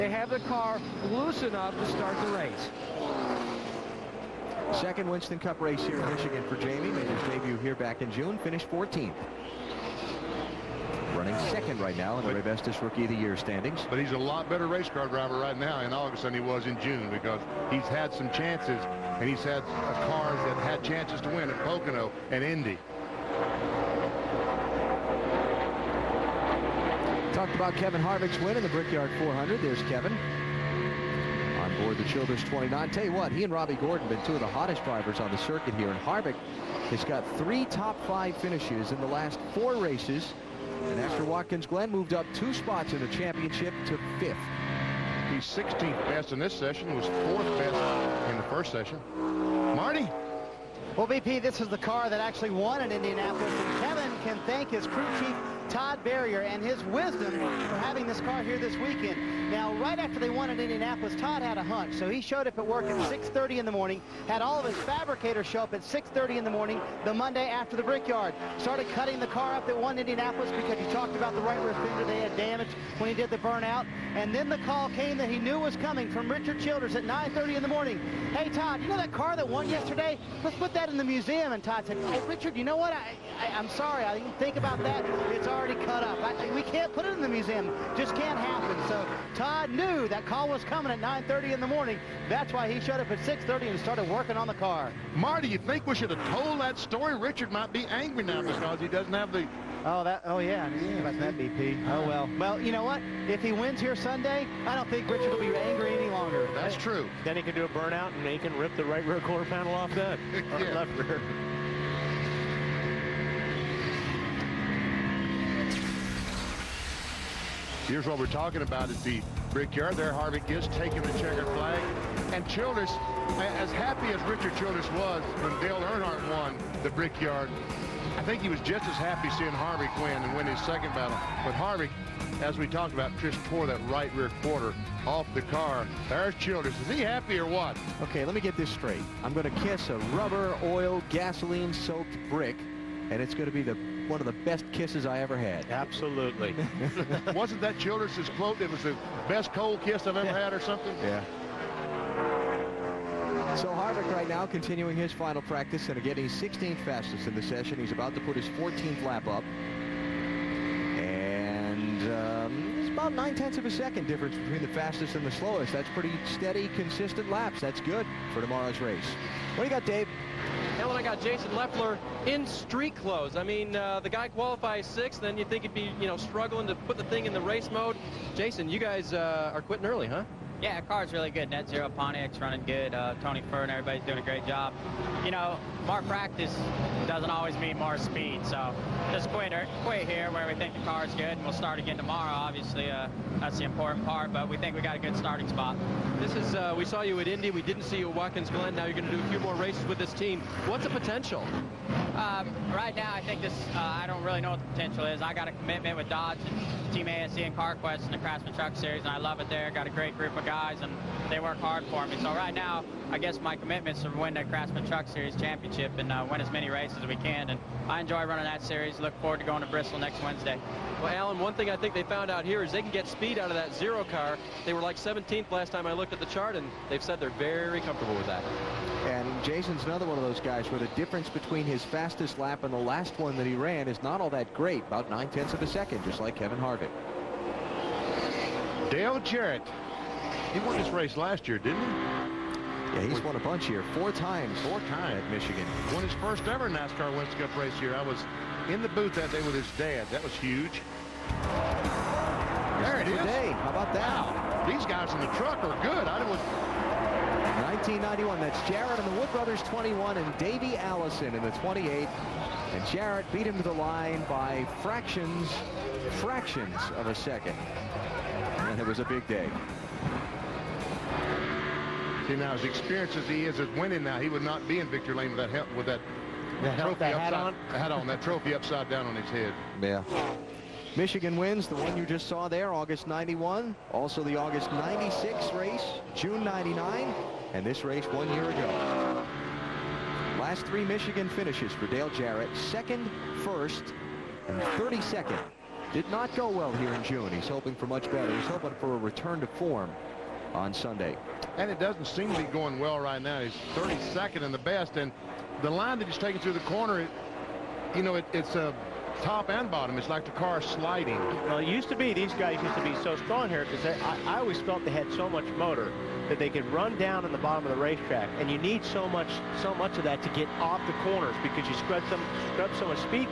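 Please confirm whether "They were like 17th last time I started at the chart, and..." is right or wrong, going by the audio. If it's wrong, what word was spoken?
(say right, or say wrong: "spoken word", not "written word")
wrong: "looked", not "started".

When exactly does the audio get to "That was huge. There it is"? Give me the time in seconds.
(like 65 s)
250 s.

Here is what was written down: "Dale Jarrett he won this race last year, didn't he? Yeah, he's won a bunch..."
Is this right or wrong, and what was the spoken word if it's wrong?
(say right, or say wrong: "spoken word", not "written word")
right.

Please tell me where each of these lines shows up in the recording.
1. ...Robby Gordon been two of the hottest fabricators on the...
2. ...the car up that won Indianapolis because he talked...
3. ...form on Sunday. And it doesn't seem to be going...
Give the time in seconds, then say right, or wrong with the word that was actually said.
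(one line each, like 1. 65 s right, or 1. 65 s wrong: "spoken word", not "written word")
1. 33 s wrong: "drivers", not "fabricators"
2. 69 s right
3. 299 s right.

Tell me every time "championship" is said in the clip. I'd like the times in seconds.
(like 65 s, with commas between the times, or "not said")
43 s, 215 s.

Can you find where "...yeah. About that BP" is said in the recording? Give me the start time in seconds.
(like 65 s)
100 s.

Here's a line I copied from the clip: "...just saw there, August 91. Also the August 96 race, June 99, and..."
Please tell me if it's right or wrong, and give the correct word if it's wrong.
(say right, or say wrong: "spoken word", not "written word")
right.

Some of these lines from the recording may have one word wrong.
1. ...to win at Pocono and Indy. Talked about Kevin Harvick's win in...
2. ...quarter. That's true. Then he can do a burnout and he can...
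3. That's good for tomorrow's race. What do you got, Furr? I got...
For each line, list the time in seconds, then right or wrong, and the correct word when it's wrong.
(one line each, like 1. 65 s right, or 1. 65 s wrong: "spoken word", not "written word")
1. 21 s right
2. 106 s wrong: "longer", not "quarter"
3. 167 s wrong: "Dave", not "Furr".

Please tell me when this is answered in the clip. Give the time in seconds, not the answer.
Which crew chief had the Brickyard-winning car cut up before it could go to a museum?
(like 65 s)
55 s.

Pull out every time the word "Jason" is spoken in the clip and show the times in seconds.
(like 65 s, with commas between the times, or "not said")
171 s, 178 s, 229 s.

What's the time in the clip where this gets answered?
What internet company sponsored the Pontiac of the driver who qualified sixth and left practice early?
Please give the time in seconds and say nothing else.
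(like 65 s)
181 s.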